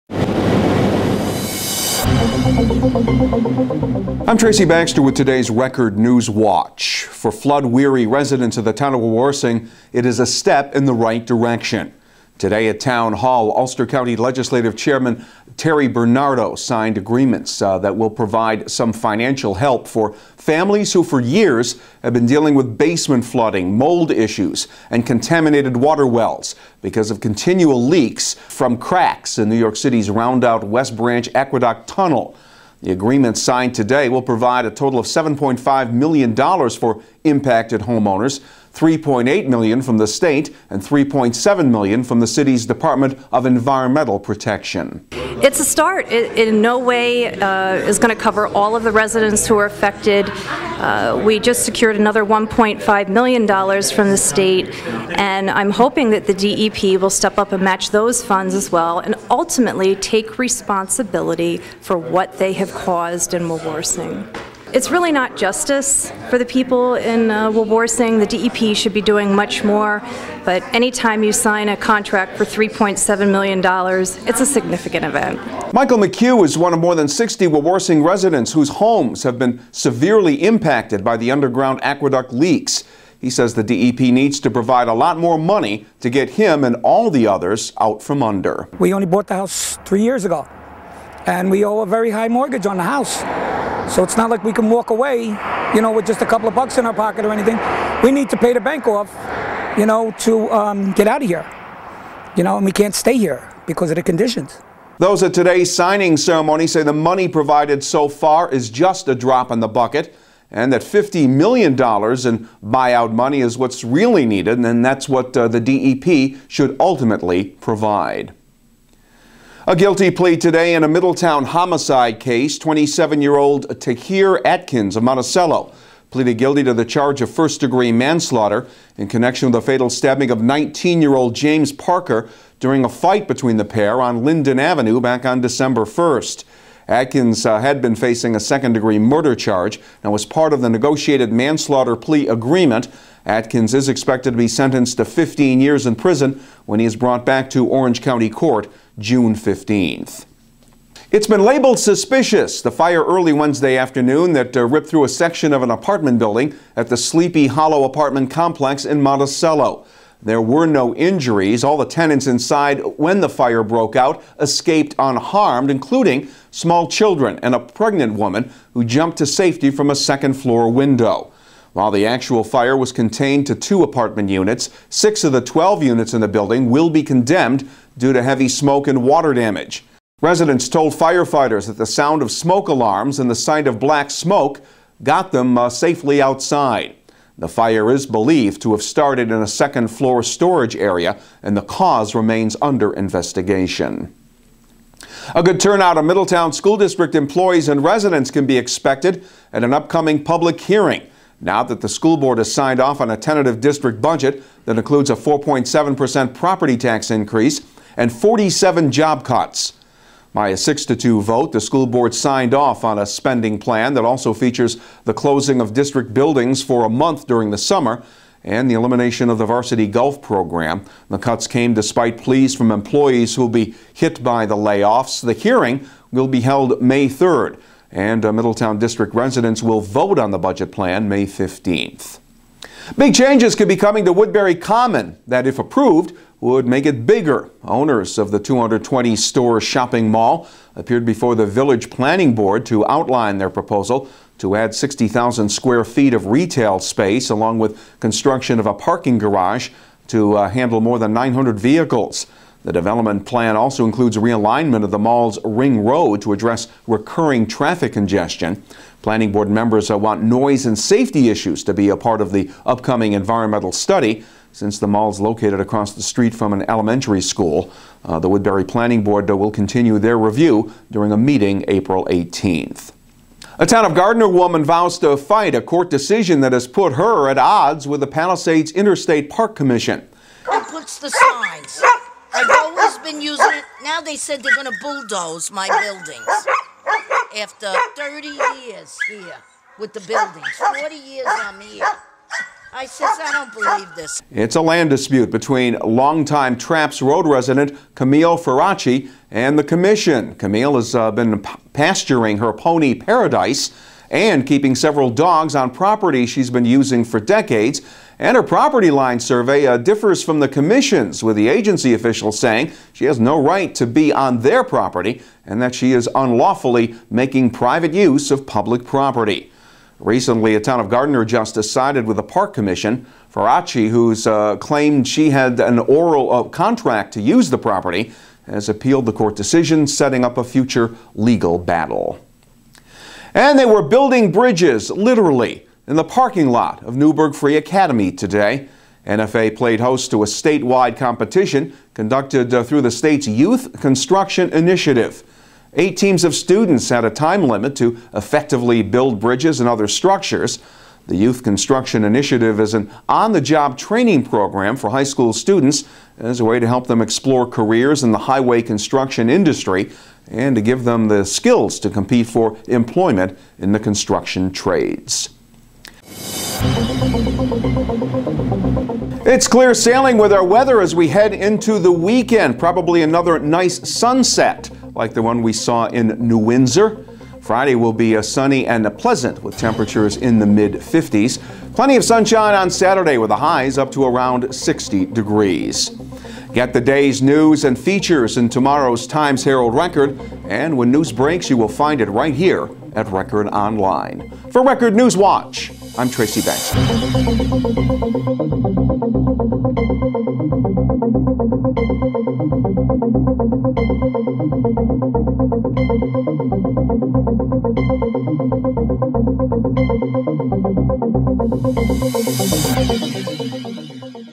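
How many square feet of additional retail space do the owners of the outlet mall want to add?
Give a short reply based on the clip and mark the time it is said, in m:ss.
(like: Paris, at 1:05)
60,000, at 4:04.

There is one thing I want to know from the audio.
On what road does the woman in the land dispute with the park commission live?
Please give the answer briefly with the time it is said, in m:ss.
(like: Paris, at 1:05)
Trapps Road, at 4:56.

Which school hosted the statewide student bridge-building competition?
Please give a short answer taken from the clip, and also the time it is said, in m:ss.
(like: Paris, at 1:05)
Newburgh Free Academy, at 5:36.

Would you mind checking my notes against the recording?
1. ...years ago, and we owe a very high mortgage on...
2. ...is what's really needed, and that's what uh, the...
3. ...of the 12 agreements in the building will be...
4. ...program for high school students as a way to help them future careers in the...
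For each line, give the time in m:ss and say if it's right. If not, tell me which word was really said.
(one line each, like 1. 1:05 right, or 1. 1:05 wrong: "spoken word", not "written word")
1. 1:30 right
2. 1:53 right
3. 2:55 wrong: "units", not "agreements"
4. 5:54 wrong: "explore", not "future".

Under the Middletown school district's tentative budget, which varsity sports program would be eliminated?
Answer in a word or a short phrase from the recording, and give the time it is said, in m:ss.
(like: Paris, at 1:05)
golf, at 3:39.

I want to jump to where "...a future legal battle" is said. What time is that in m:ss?
5:30.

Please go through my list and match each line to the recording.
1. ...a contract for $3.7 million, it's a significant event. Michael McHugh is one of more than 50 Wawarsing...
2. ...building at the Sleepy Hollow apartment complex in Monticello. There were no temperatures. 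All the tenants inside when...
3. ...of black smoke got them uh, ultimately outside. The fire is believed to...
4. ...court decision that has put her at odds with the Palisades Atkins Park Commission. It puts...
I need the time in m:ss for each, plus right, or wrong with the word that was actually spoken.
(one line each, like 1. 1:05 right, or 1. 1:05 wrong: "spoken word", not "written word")
1. 1:11 wrong: "60", not "50"
2. 2:36 wrong: "injuries", not "temperatures"
3. 3:03 wrong: "safely", not "ultimately"
4. 4:35 wrong: "Interstate", not "Atkins".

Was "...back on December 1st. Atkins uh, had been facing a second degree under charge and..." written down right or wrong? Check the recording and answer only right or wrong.
wrong.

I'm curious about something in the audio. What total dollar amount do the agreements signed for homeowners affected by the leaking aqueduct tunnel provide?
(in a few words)
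$7.5 million.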